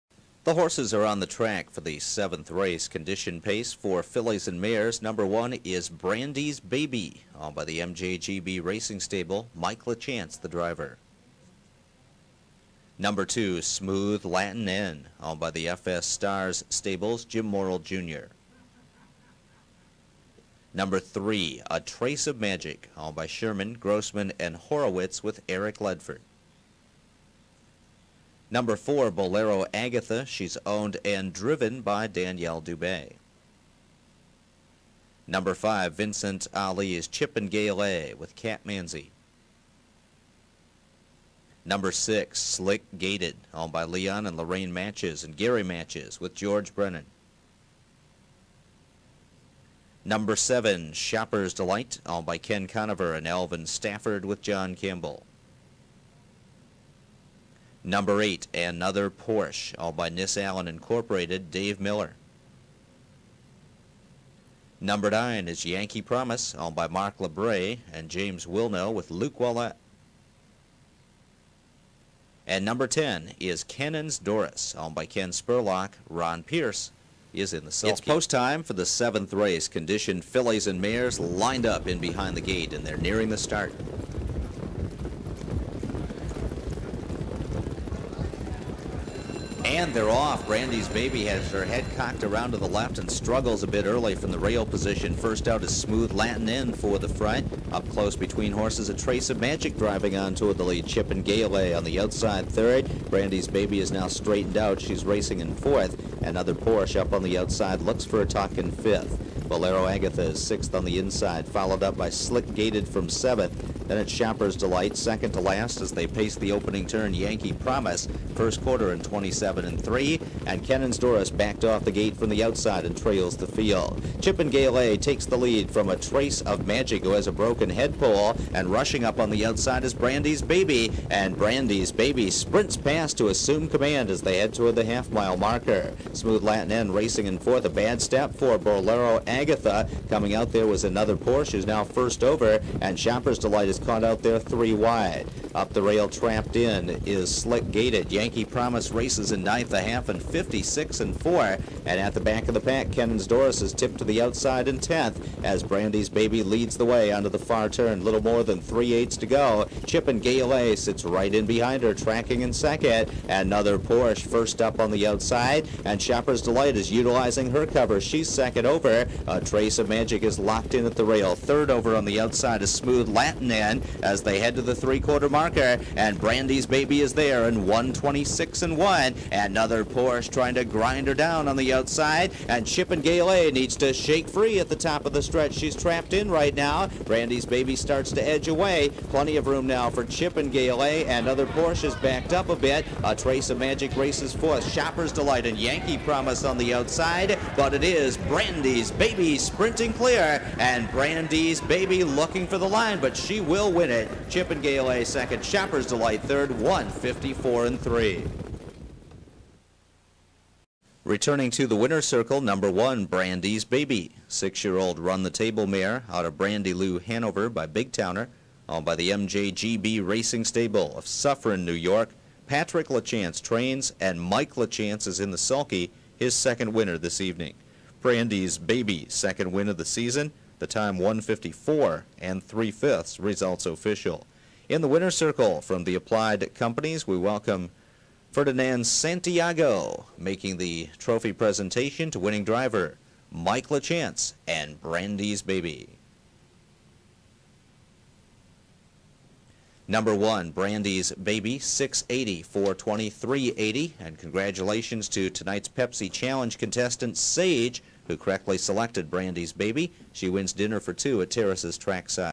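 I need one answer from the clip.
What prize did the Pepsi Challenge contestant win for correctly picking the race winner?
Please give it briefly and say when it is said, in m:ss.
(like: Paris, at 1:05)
Dinner for two, at 4:20.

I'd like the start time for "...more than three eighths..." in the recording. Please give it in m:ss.
2:38.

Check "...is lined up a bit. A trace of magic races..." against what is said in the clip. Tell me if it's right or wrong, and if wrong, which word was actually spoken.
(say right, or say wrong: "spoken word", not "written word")
wrong: "backed", not "lined".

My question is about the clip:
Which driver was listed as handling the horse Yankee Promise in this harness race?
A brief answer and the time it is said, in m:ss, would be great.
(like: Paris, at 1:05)
Luc Ouellette, at 1:09.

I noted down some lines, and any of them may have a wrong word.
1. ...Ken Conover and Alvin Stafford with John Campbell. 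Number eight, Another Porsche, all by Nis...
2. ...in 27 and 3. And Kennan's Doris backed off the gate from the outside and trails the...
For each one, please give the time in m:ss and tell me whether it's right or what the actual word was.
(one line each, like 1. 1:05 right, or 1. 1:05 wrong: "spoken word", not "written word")
1. 0:52 right
2. 1:58 right.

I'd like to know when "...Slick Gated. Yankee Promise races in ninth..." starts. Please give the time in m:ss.
2:27.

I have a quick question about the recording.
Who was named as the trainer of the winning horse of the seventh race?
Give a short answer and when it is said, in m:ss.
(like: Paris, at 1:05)
Patrick LaChance, at 3:42.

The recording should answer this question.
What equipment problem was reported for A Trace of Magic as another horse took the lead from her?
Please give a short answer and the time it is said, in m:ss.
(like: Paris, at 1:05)
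Broken head pole, at 2:07.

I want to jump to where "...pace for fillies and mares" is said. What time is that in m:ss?
0:03.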